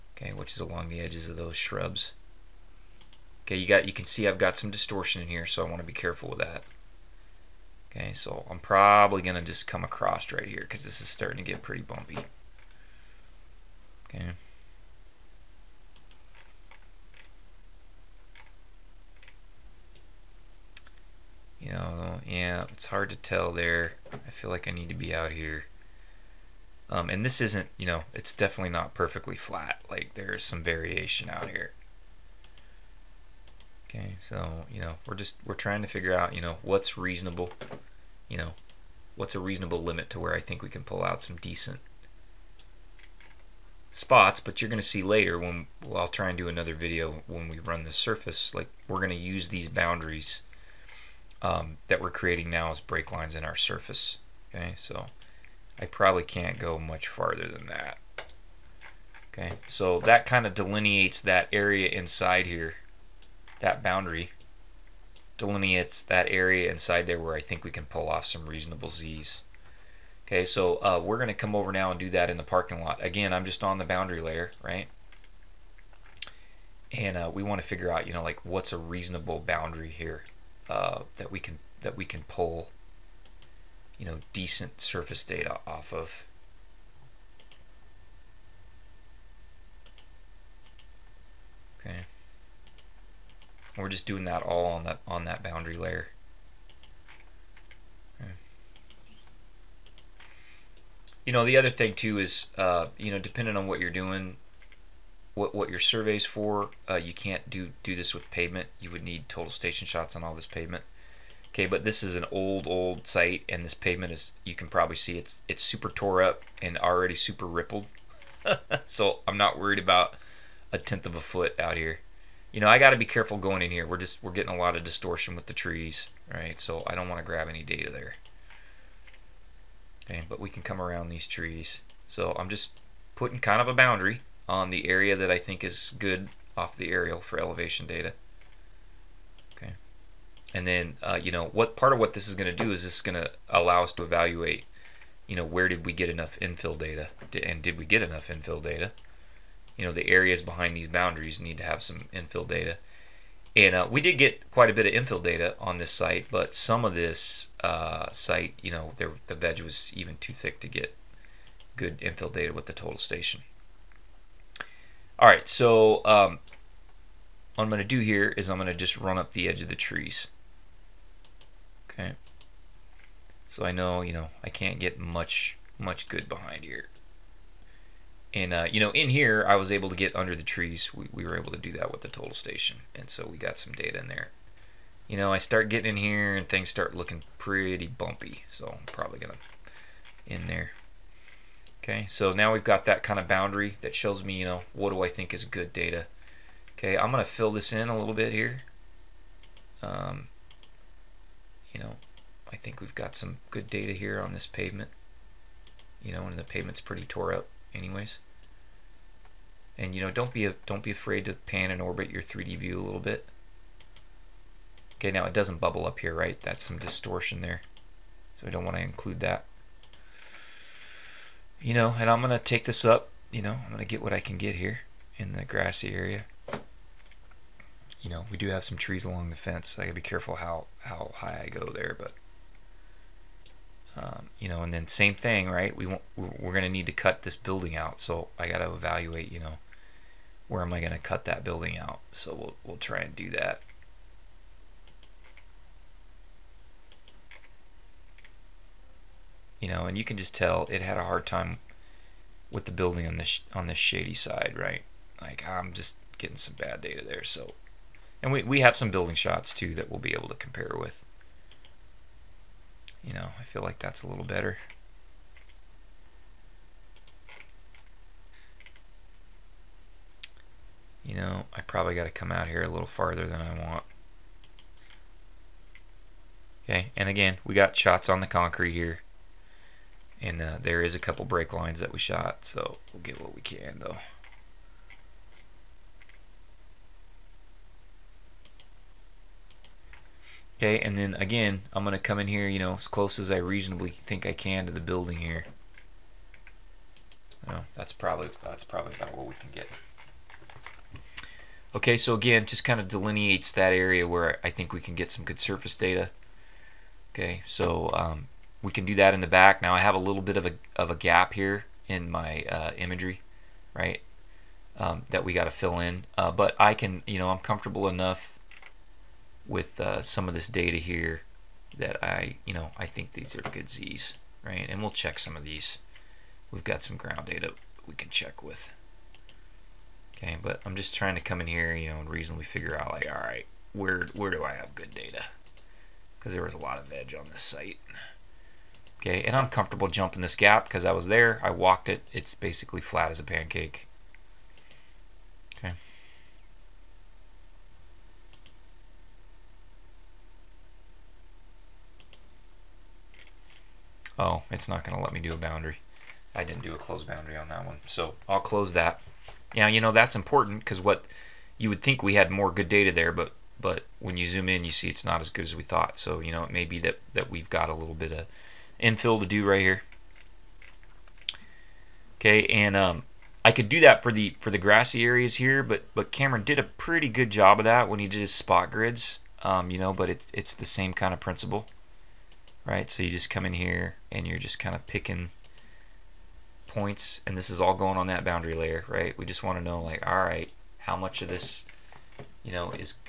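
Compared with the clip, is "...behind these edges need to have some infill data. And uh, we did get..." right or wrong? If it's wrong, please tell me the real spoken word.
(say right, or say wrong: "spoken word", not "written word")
wrong: "boundaries", not "edges".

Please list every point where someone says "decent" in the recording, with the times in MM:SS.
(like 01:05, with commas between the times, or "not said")
00:41, 01:24.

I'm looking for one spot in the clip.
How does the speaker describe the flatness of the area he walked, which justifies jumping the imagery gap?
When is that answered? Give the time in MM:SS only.
05:42.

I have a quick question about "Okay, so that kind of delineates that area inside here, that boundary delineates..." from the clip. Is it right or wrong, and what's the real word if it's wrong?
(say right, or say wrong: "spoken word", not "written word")
right.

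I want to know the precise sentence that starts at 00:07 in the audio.
Okay, so I'm probably going to just come across right here because this is starting to get pretty bumpy.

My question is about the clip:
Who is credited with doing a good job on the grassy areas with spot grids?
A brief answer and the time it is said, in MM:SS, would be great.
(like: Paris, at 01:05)
Cameron, at 06:16.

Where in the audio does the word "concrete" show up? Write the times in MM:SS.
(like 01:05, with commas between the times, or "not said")
04:38.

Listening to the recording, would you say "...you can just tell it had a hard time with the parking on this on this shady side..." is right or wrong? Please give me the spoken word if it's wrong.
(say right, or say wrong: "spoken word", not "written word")
wrong: "building", not "parking".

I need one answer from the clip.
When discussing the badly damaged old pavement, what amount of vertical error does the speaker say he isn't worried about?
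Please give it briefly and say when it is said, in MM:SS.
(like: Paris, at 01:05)
a tenth of a foot, at 02:00.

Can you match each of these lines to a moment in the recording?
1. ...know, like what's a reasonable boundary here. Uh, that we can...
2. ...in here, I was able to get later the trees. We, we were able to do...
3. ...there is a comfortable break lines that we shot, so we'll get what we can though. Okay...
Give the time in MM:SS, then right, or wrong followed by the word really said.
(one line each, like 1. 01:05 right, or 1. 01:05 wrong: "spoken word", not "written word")
1. 01:18 right
2. 02:58 wrong: "under", not "later"
3. 04:40 wrong: "couple", not "comfortable".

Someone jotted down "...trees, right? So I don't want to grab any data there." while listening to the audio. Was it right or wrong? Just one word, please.
right.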